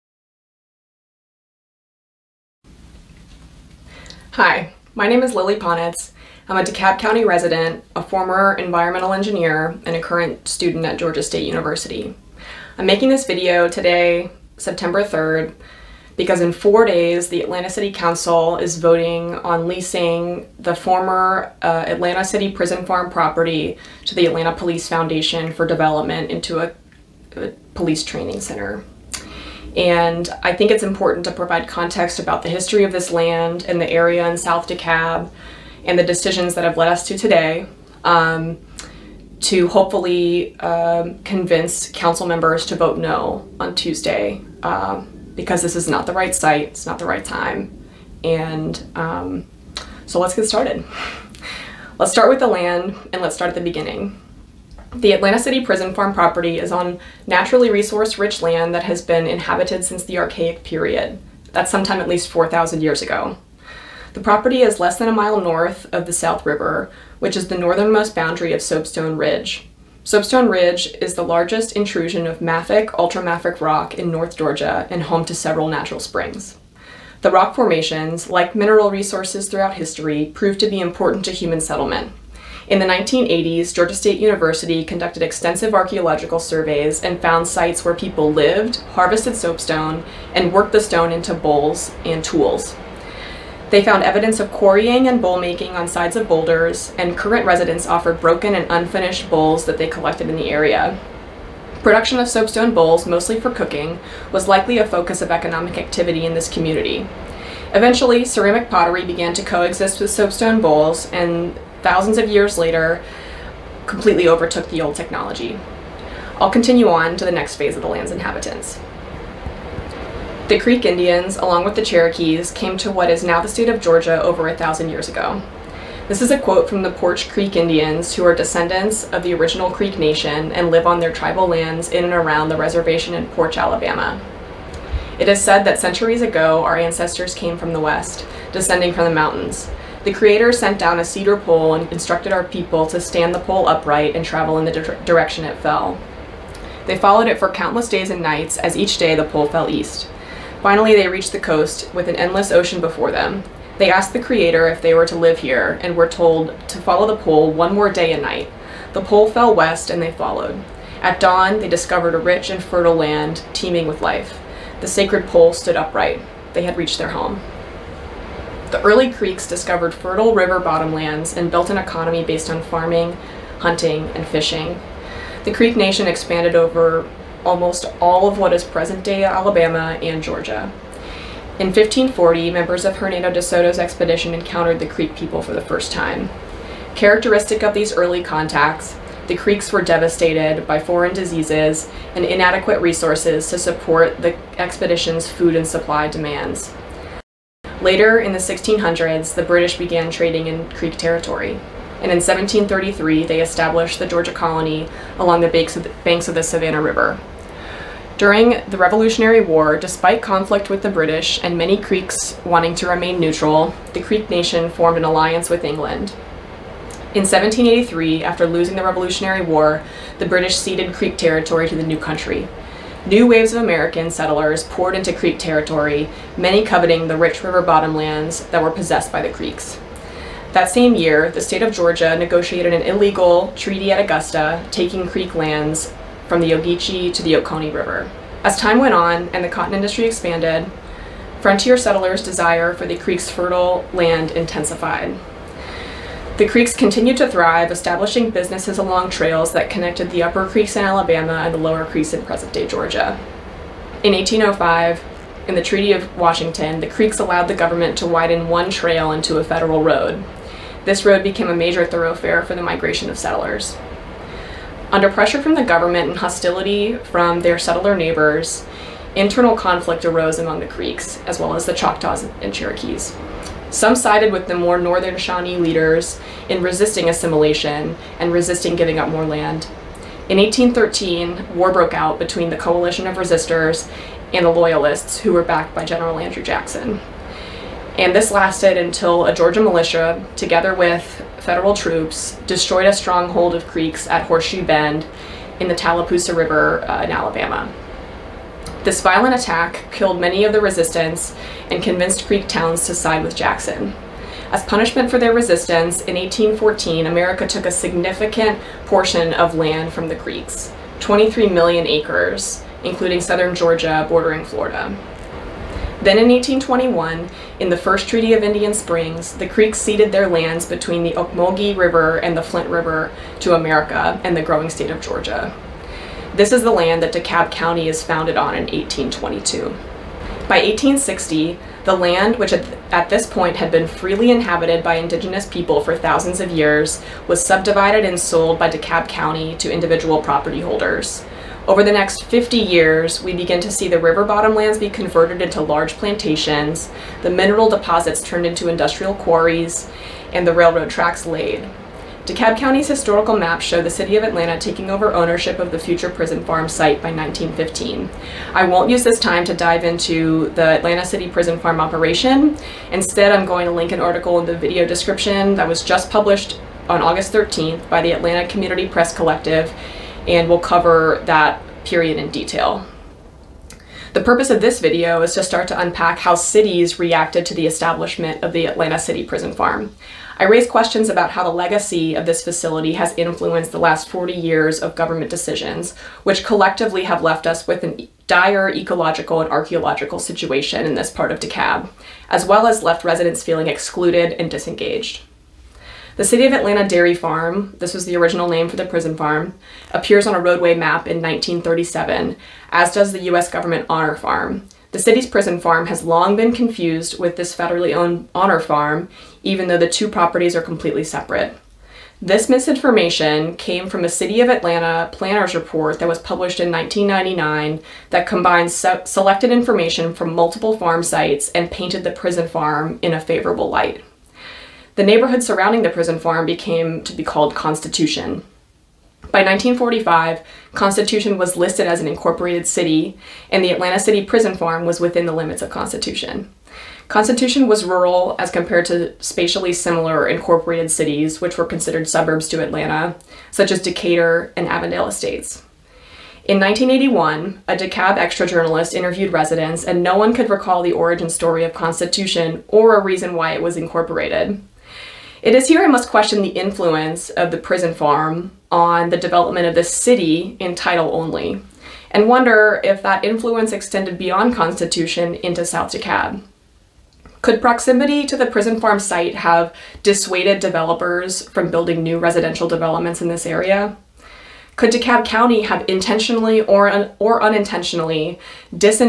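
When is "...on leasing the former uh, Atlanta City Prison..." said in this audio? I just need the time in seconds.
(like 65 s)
19 s.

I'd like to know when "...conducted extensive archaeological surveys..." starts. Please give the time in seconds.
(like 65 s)
84 s.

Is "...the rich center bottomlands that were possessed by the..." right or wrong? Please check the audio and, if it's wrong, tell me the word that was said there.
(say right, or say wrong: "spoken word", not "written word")
wrong: "river", not "center".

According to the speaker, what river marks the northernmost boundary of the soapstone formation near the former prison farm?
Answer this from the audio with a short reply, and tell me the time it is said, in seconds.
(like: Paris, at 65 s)
South River, at 66 s.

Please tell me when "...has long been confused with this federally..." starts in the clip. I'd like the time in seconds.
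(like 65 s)
405 s.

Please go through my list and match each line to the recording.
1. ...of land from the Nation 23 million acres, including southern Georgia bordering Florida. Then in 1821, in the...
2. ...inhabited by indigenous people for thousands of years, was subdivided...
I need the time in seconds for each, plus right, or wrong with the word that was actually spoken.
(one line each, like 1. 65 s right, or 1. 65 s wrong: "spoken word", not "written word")
1. 309 s wrong: "Creeks", not "Nation"
2. 334 s right.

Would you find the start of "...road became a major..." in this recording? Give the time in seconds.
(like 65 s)
261 s.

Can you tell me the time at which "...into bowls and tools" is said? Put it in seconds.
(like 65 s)
91 s.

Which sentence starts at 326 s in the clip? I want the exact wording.
This is the land that DeKalb County is founded on in 1822.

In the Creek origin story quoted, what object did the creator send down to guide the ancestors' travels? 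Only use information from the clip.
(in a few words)
a cedar pole.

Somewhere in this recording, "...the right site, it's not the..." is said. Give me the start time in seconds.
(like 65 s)
46 s.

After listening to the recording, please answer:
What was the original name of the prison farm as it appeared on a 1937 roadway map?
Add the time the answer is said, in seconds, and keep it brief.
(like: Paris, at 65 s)
City of Atlanta Dairy Farm, at 396 s.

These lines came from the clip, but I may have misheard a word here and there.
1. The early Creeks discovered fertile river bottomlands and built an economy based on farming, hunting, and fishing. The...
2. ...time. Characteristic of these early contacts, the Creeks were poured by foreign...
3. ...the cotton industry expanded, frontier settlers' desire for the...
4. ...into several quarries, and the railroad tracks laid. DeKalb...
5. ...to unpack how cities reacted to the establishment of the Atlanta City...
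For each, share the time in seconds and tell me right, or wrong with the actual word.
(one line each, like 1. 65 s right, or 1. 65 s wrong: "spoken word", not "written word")
1. 168 s right
2. 185 s wrong: "devastated", not "poured"
3. 239 s right
4. 348 s wrong: "industrial", not "several"
5. 375 s right.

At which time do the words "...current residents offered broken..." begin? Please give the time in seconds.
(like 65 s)
97 s.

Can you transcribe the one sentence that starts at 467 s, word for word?
Could proximity to the prison farm site have dissuaded developers from building new residential developments in this area?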